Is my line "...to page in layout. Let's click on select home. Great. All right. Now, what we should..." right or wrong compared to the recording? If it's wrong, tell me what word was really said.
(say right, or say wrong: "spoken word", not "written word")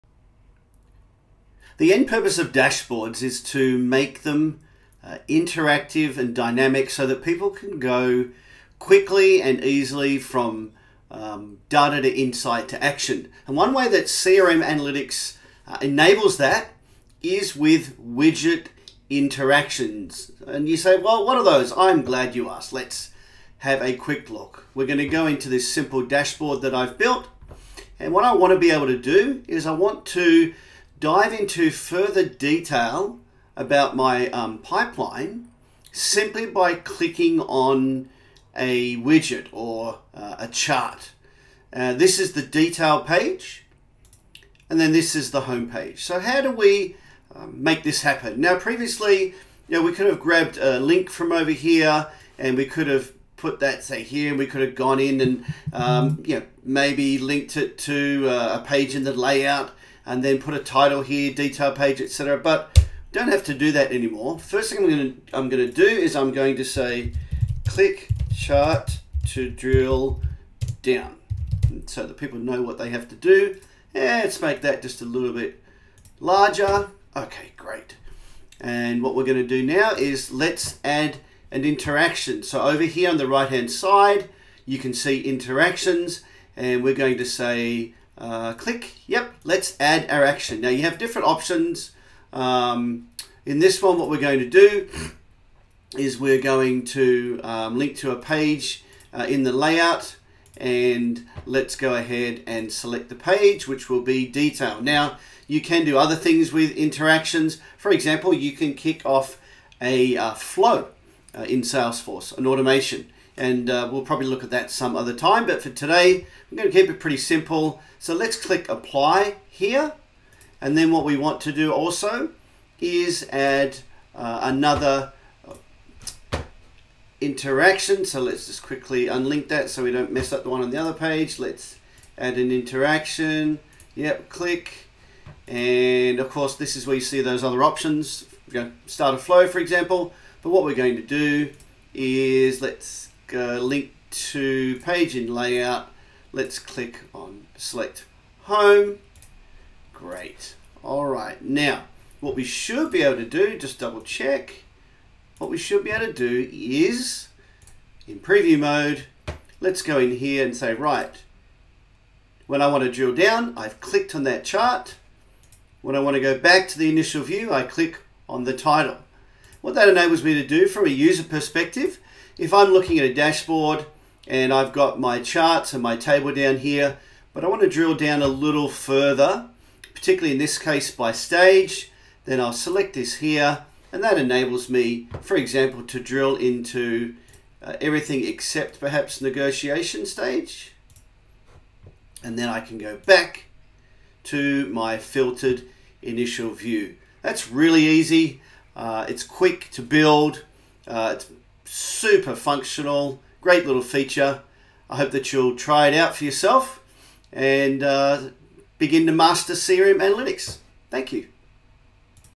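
right.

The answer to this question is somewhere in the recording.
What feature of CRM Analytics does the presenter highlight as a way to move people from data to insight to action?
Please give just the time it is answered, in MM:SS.
00:17.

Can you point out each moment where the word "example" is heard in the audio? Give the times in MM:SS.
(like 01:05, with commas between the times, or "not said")
01:47, 02:19, 03:05.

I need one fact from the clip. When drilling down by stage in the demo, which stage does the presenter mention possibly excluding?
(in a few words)
Negotiation.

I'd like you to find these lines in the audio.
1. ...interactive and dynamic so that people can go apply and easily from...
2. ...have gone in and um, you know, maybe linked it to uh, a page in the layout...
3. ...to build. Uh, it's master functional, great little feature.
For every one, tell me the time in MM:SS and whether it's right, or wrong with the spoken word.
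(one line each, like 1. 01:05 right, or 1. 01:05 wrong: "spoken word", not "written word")
1. 00:05 wrong: "quickly", not "apply"
2. 00:54 right
3. 03:19 wrong: "super", not "master".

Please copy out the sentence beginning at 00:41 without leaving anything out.
Uh, this is the detail page, and then this is the home page.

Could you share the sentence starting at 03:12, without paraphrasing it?
And then I can go back to my filtered initial view.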